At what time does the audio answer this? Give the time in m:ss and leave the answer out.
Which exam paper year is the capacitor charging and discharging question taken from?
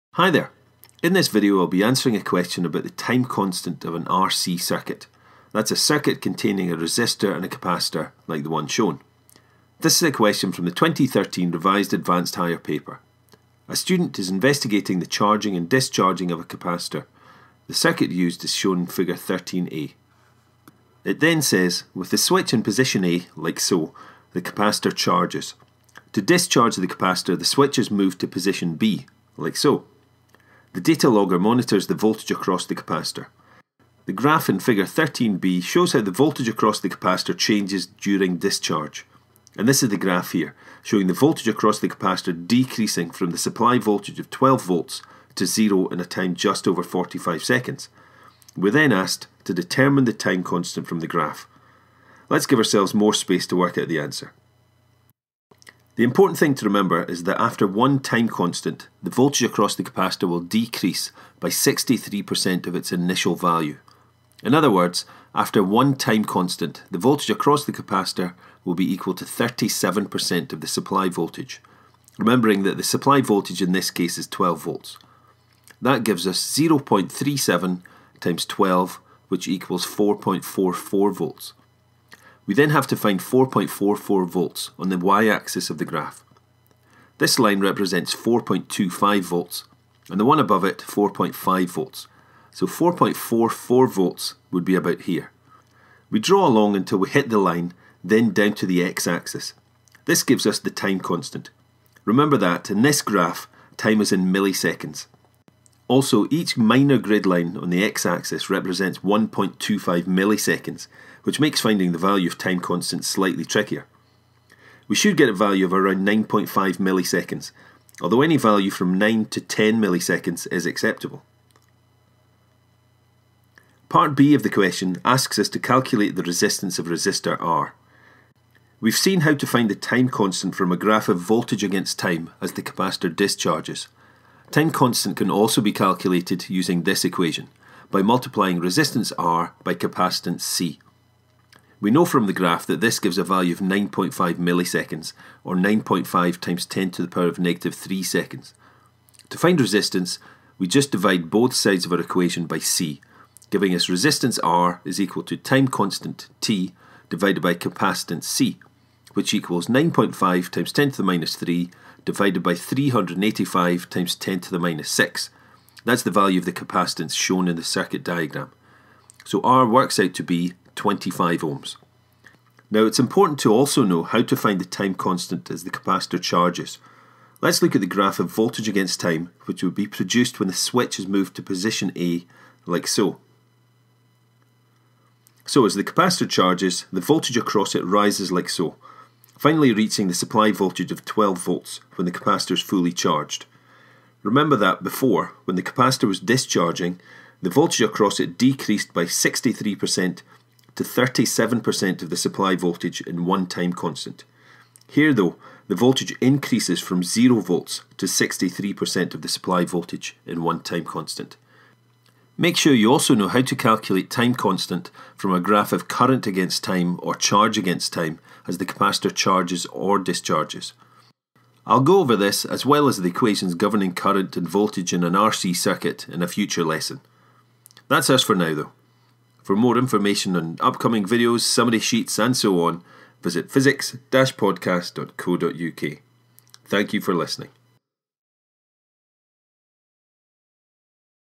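0:10.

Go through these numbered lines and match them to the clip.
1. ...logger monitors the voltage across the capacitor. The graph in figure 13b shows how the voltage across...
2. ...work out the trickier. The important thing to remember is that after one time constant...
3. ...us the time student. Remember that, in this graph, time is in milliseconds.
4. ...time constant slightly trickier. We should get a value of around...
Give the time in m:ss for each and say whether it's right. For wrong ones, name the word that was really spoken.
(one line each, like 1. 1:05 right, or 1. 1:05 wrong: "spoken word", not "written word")
1. 0:31 right
2. 0:53 wrong: "answer", not "trickier"
3. 1:40 wrong: "constant", not "student"
4. 1:52 right.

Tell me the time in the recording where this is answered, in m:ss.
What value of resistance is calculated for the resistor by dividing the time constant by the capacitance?
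2:50.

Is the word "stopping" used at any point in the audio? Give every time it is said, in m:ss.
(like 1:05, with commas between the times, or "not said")
not said.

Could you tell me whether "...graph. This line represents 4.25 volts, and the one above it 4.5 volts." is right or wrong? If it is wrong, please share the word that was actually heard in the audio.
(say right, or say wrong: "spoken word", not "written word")
right.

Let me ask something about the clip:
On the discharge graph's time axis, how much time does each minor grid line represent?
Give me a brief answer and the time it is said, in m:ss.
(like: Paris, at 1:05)
1.25 milliseconds, at 1:48.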